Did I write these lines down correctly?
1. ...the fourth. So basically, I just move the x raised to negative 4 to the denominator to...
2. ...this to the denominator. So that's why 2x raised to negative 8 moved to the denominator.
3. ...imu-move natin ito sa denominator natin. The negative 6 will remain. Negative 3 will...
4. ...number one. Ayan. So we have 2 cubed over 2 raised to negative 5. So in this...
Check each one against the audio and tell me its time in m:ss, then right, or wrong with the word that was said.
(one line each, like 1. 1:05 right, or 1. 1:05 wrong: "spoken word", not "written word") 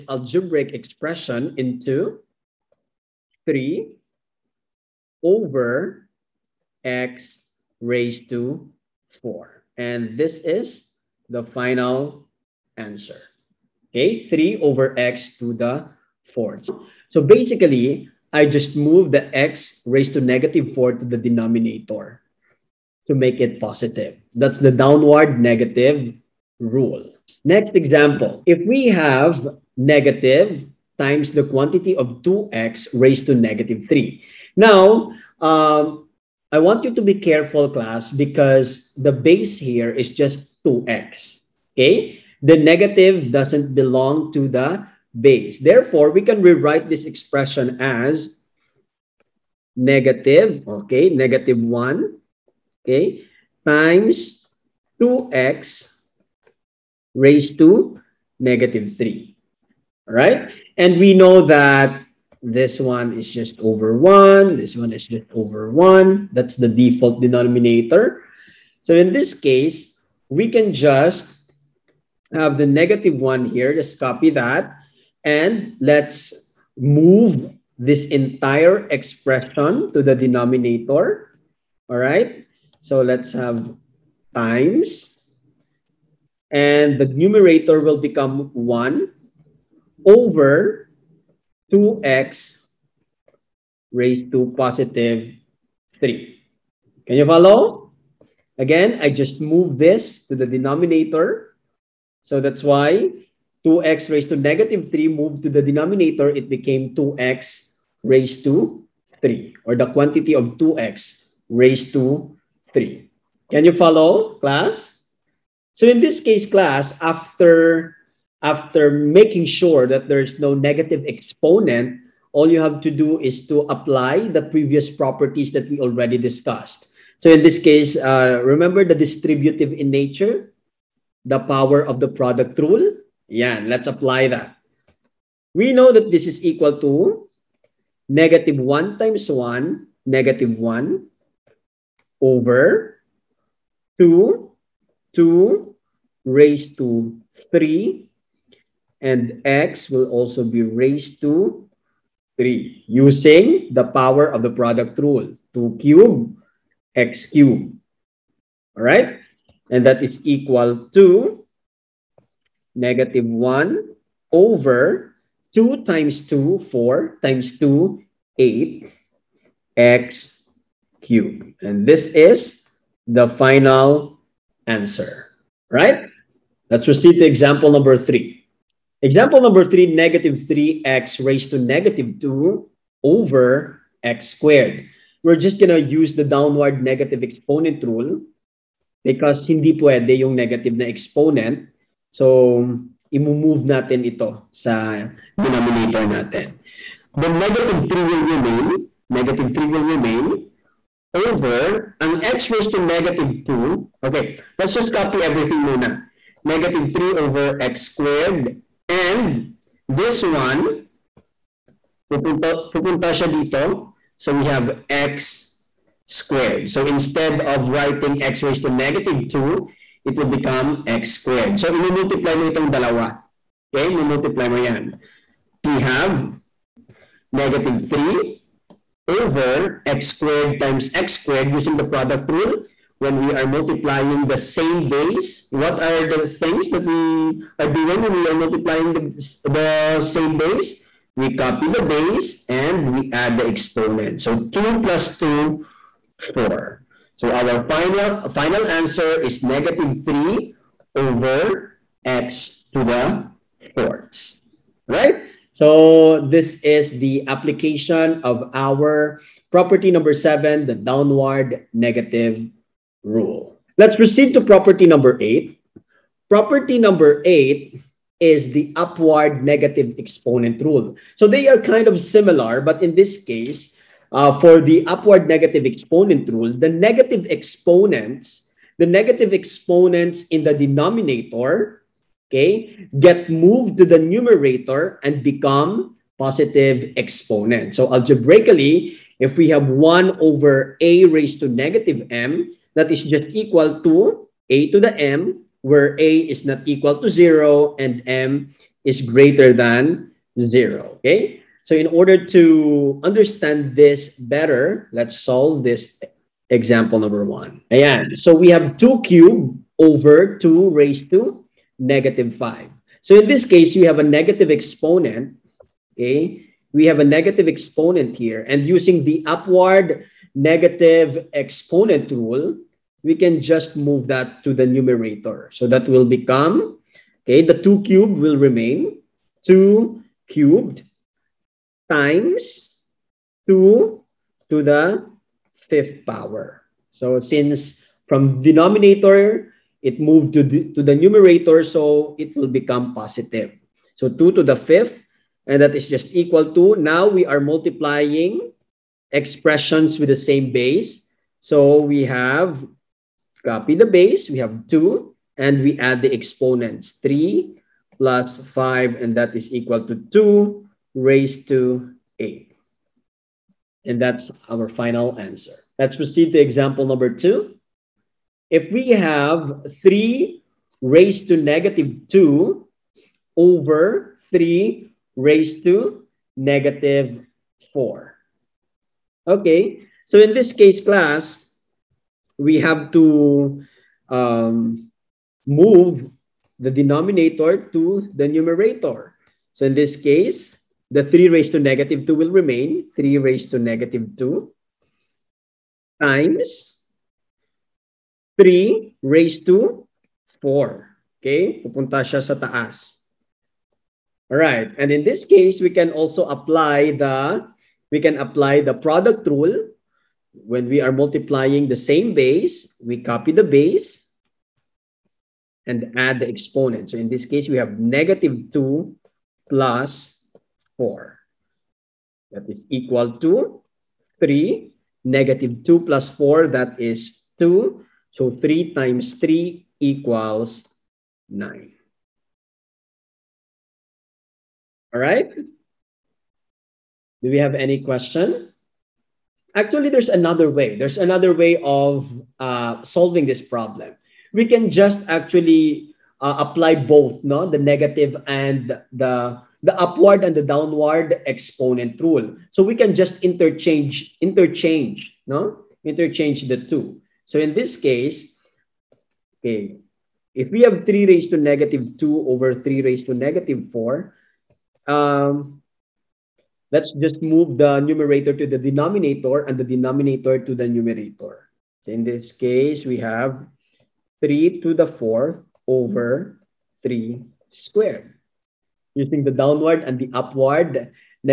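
1. 0:15 right
2. 1:39 wrong: "3", not "8"
3. 3:13 wrong: "3", not "6"
4. 5:06 right.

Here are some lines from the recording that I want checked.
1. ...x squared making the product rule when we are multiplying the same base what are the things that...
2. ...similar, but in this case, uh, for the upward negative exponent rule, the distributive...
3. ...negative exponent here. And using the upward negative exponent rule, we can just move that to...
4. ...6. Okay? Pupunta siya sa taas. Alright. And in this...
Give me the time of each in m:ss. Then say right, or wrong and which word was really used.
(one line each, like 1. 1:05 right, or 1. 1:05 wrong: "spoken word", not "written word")
1. 3:50 wrong: "using", not "making"
2. 4:31 wrong: "negative", not "distributive"
3. 5:17 right
4. 6:40 wrong: "4", not "6".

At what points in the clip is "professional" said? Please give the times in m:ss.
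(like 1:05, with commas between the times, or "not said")
not said.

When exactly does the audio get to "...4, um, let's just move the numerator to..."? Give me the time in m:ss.
7:43.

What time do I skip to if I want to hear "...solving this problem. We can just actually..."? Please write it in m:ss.
7:22.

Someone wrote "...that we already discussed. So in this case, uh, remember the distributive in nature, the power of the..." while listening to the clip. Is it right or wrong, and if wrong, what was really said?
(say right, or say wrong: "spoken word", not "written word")
right.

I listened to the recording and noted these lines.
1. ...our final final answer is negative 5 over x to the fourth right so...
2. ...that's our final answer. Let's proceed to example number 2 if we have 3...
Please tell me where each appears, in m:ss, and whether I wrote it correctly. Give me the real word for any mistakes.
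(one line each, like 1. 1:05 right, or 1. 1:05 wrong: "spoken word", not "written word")
1. 4:07 wrong: "3", not "5"
2. 6:03 right.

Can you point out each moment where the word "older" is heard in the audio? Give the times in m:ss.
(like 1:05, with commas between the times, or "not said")
not said.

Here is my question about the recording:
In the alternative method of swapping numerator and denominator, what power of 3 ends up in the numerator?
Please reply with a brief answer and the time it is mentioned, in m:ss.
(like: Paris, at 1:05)
4th, at 7:54.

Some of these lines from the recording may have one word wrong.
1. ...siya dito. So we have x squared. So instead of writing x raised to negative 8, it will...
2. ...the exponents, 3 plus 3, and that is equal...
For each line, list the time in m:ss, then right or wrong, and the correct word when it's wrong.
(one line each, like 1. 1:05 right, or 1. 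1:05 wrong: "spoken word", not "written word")
1. 3:33 wrong: "2", not "8"
2. 5:56 wrong: "5", not "3".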